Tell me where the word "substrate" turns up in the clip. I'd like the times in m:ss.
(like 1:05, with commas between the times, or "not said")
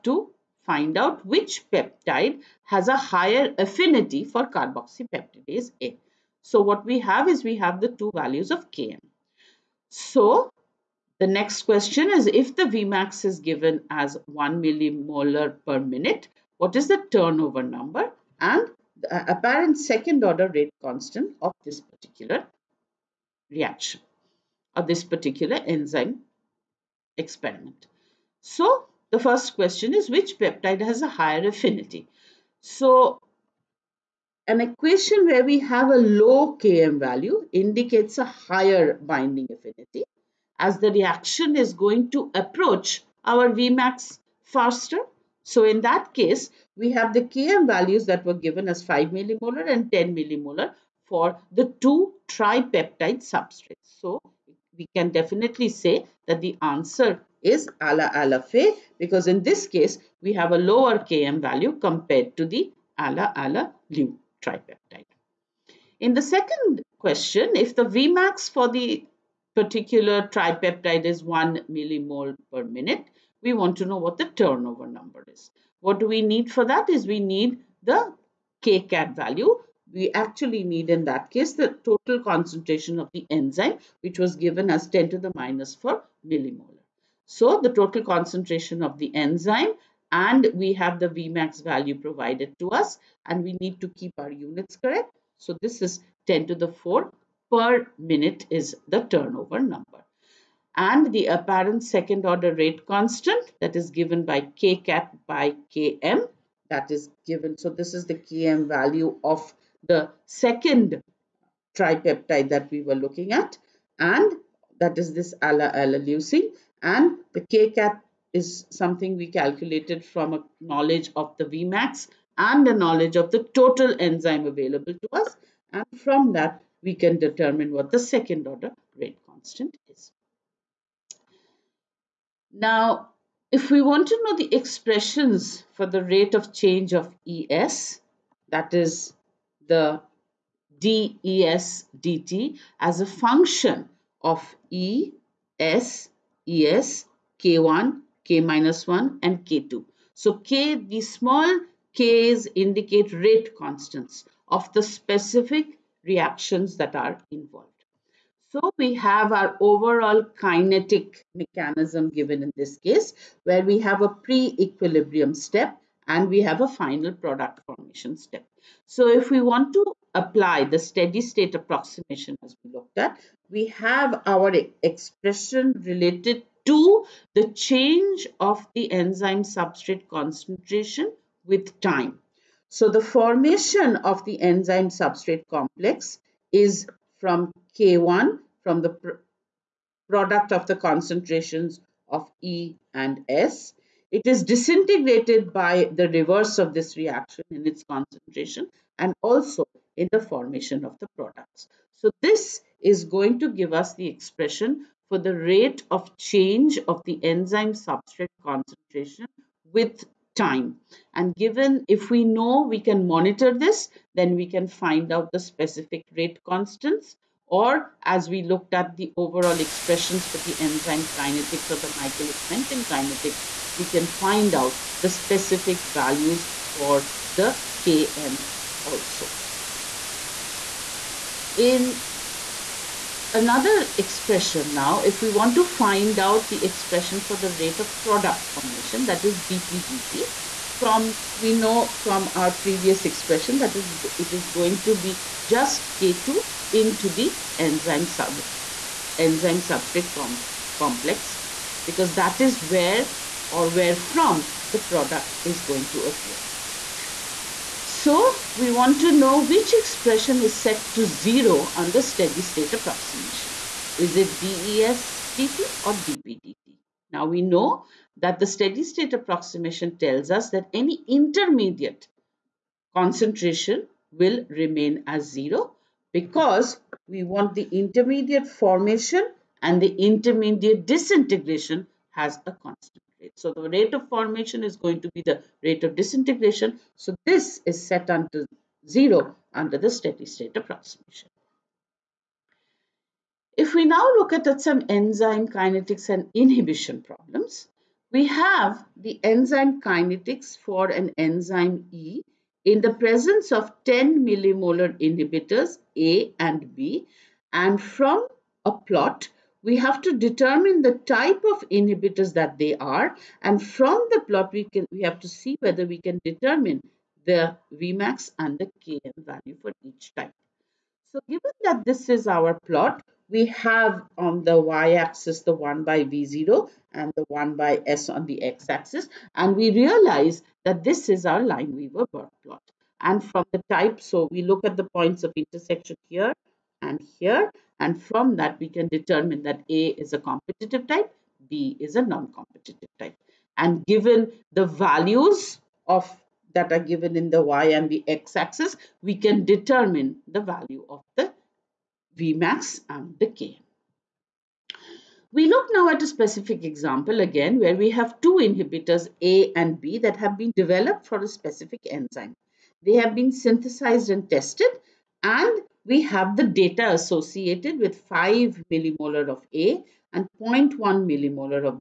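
0:53, 2:59, 3:04, 3:27, 4:09.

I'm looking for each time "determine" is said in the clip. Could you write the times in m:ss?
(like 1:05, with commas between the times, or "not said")
2:07, 5:10, 5:16, 5:38, 5:49.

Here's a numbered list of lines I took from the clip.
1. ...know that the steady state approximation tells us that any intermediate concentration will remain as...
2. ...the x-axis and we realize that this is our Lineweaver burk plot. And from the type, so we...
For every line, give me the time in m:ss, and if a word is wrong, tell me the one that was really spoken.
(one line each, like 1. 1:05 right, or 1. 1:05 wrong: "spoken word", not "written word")
1. 4:27 right
2. 5:28 right.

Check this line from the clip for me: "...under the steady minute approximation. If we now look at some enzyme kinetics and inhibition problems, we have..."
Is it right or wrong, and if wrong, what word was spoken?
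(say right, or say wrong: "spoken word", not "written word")
wrong: "state", not "minute".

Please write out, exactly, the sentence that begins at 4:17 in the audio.
So we want to know which expression is set to zero under steady state approximation.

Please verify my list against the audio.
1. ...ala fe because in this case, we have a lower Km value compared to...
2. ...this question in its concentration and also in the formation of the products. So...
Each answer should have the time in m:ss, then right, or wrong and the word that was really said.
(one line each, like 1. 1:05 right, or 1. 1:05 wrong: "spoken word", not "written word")
1. 0:58 right
2. 3:16 wrong: "reaction", not "question".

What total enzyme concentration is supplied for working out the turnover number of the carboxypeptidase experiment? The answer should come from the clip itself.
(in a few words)
10^-4 millimolar.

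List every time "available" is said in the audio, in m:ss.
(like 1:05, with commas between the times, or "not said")
2:04.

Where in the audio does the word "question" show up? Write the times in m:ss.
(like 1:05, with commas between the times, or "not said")
0:11, 0:29, 1:06.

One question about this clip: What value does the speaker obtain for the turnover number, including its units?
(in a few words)
10^4 per minute.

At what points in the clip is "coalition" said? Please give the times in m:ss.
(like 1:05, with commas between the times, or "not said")
not said.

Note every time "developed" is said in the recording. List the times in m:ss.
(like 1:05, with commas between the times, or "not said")
6:00.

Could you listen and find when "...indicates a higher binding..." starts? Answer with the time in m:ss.
0:37.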